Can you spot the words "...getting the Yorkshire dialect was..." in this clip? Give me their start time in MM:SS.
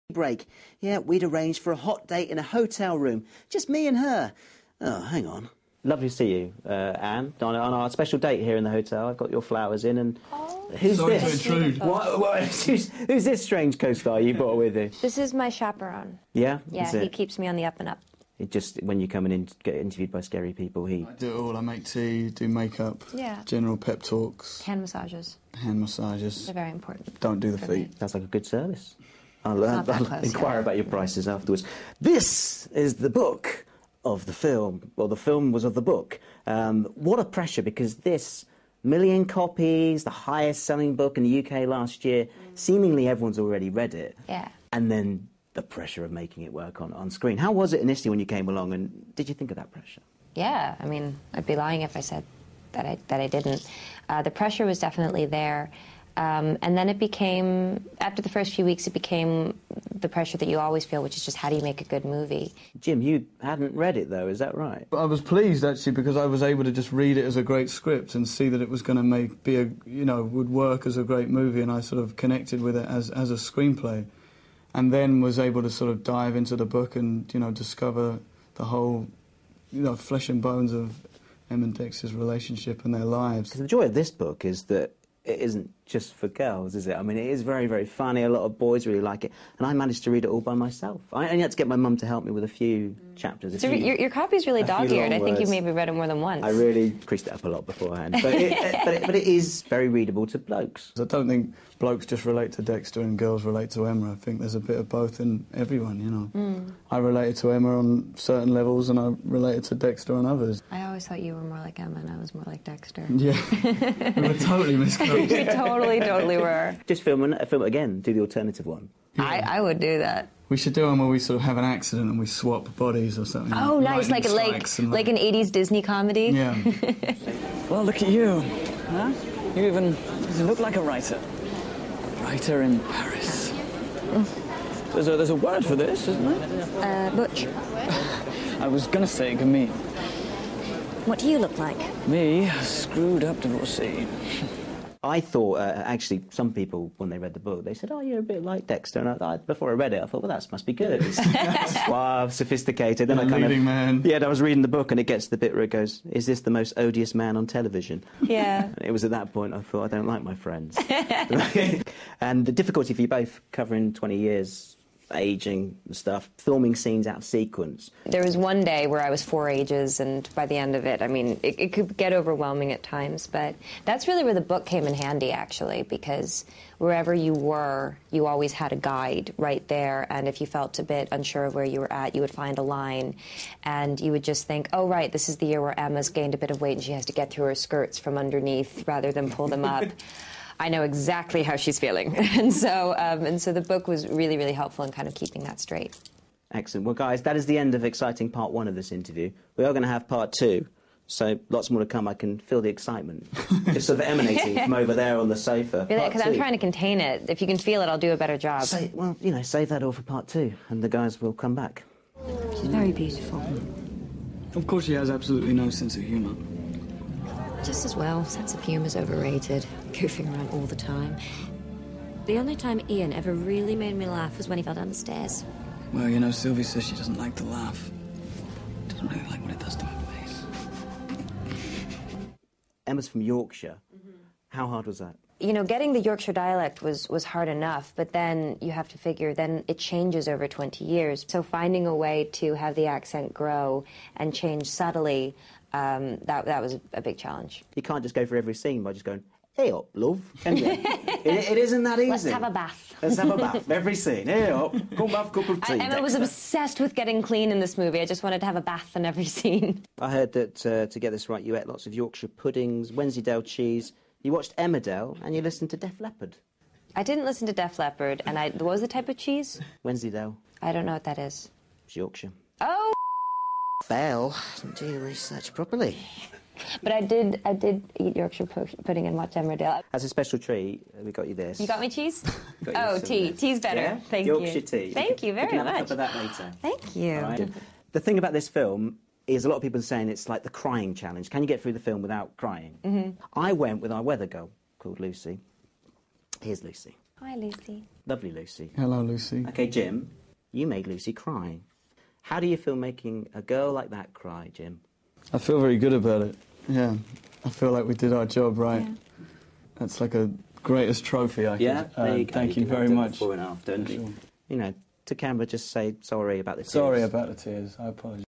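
03:55.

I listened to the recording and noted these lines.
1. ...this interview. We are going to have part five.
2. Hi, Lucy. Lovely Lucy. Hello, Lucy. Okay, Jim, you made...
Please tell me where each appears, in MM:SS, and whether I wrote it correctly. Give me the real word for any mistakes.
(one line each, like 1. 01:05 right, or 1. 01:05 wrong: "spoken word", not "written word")
1. 03:18 wrong: "two", not "five"
2. 04:57 right.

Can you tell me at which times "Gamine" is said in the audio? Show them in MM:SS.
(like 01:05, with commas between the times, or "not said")
02:19.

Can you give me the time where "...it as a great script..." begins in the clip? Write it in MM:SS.
01:07.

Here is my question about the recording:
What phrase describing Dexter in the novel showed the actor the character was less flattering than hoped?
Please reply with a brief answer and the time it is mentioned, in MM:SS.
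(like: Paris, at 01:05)
The most odious man on television, at 02:36.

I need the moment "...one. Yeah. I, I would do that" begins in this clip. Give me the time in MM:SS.
01:58.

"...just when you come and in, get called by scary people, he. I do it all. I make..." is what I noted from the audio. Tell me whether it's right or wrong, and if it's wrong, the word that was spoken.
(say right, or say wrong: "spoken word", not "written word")
wrong: "interviewed", not "called".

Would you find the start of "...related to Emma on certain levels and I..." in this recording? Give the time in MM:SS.
01:46.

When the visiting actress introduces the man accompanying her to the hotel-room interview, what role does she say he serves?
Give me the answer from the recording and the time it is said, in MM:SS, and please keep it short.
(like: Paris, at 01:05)
Chaperone, at 00:15.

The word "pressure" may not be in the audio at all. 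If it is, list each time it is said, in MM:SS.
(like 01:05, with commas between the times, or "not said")
00:37, 00:45, 00:49, 00:54, 01:00.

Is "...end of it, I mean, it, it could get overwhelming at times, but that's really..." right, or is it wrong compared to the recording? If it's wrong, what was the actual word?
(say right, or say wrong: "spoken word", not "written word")
right.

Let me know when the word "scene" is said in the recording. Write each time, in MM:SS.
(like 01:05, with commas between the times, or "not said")
02:46, 04:08, 04:13, 04:19.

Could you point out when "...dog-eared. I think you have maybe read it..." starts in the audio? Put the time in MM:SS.
01:34.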